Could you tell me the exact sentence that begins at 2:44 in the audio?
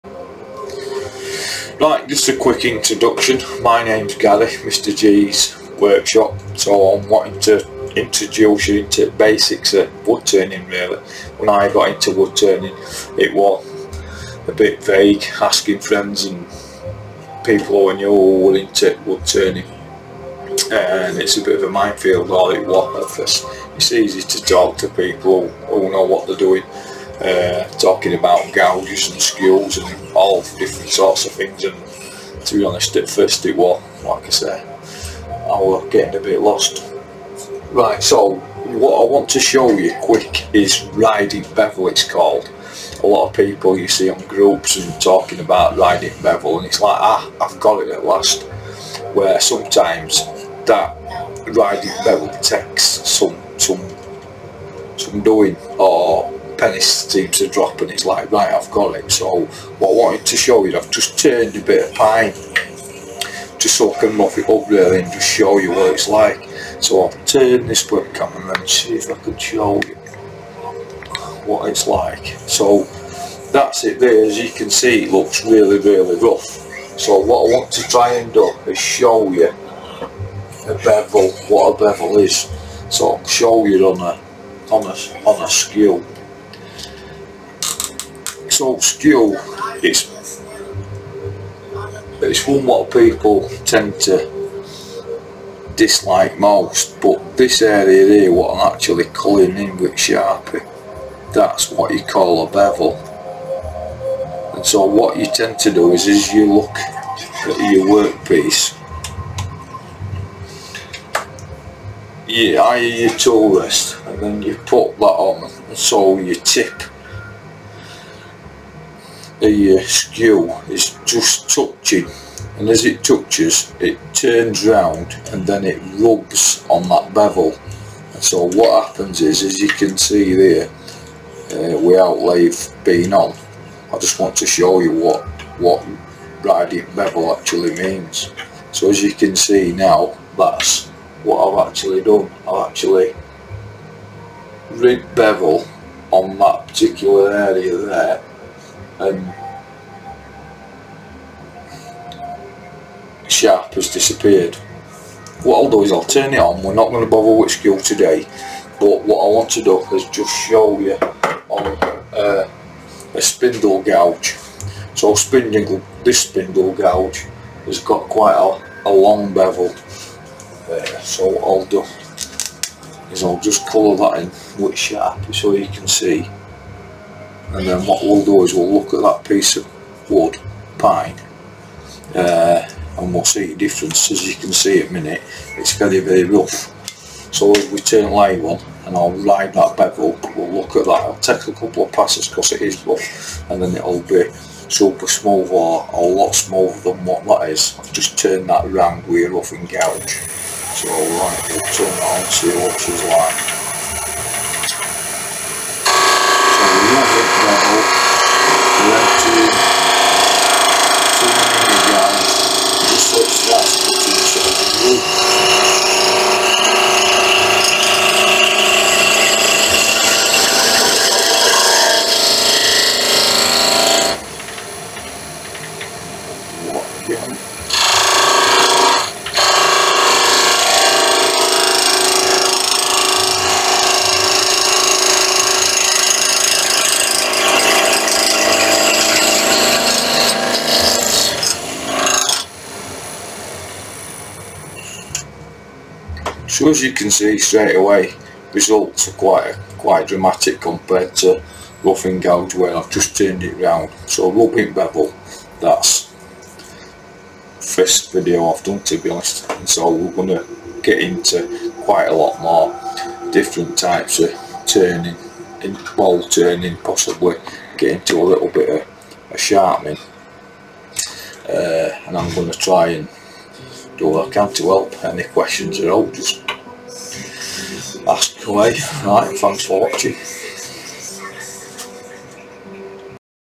So spindle, this spindle gouge has got quite a, a long bevel.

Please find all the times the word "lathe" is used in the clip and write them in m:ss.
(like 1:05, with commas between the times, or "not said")
2:12.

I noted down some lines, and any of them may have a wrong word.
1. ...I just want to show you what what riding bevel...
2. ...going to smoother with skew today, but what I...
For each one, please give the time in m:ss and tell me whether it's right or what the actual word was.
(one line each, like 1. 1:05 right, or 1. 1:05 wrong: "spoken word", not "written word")
1. 2:13 right
2. 2:36 wrong: "bother", not "smoother".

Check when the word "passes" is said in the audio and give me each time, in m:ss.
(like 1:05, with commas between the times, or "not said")
3:11.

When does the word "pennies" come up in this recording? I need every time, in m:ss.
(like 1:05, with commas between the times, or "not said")
0:56.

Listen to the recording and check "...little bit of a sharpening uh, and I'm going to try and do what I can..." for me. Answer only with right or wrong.
right.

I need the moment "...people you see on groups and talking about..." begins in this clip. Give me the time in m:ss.
0:43.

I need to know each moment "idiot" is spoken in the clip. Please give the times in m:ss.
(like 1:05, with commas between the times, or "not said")
not said.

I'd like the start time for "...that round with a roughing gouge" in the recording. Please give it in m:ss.
3:18.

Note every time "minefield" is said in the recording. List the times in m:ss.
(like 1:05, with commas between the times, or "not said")
0:21.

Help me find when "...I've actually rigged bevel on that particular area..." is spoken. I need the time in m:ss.
2:22.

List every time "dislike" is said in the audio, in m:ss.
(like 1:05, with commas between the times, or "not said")
1:35.